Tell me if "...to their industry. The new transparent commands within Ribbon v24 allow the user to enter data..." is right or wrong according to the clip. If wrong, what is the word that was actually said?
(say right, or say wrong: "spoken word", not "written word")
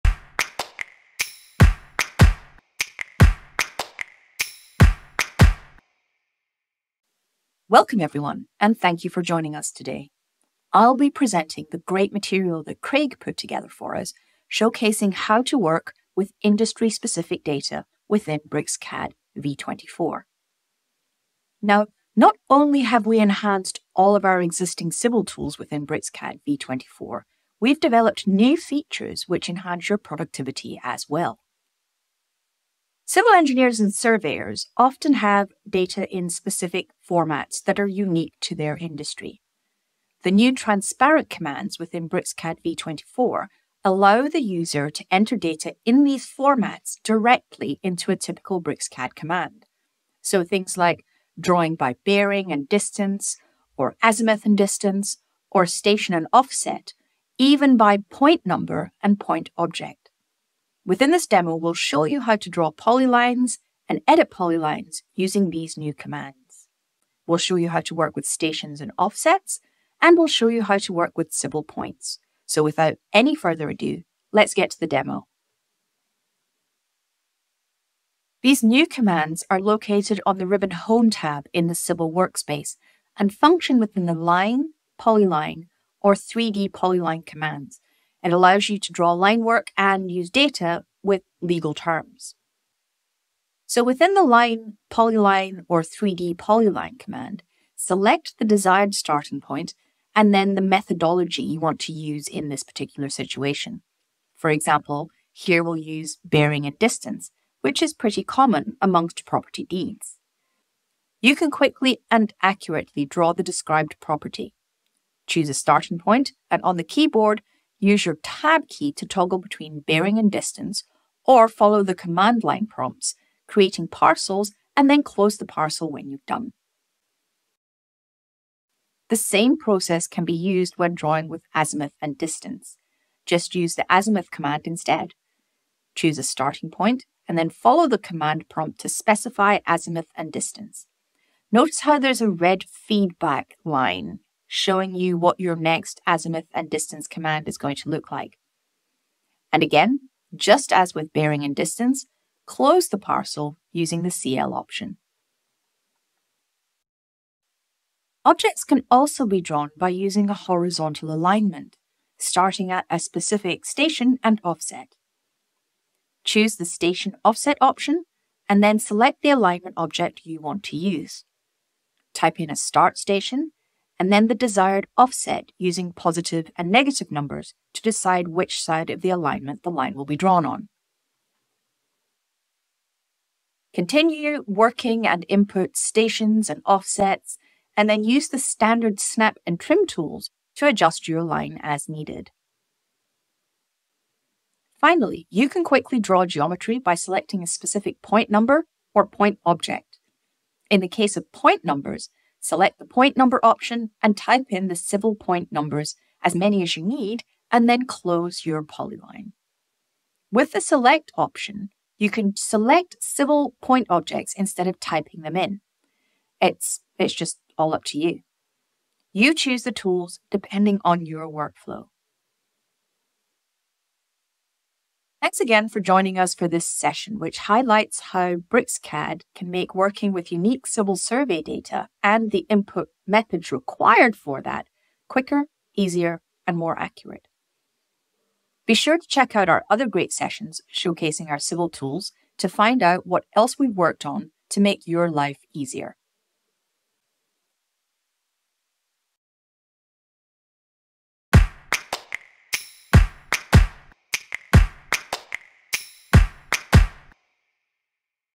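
wrong: "BricsCAD", not "Ribbon".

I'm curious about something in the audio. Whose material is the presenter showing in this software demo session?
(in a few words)
Craig.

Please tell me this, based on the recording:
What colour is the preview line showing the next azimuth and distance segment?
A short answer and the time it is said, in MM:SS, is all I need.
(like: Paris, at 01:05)
Red, at 02:22.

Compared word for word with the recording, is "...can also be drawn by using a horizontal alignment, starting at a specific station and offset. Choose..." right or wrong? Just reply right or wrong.
right.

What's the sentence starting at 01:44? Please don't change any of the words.
For example, here we'll use bearing and distance, which is pretty common amongst property deeds.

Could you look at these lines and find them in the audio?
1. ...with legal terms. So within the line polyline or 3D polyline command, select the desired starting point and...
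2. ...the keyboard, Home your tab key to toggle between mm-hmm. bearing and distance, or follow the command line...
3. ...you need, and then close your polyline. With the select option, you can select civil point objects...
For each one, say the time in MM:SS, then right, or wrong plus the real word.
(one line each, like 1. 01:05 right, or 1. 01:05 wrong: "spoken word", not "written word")
1. 01:31 right
2. 01:56 wrong: "Use", not "Home"
3. 03:26 right.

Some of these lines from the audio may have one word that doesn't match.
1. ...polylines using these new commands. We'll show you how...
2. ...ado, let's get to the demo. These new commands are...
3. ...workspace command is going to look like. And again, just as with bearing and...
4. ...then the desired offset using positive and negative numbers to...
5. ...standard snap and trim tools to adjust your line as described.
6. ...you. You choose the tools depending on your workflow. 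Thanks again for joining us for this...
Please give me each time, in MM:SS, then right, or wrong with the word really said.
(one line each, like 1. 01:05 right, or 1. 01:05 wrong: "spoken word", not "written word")
1. 01:04 right
2. 01:13 right
3. 02:26 wrong: "distance", not "workspace"
4. 02:54 right
5. 03:08 wrong: "needed", not "described"
6. 03:37 right.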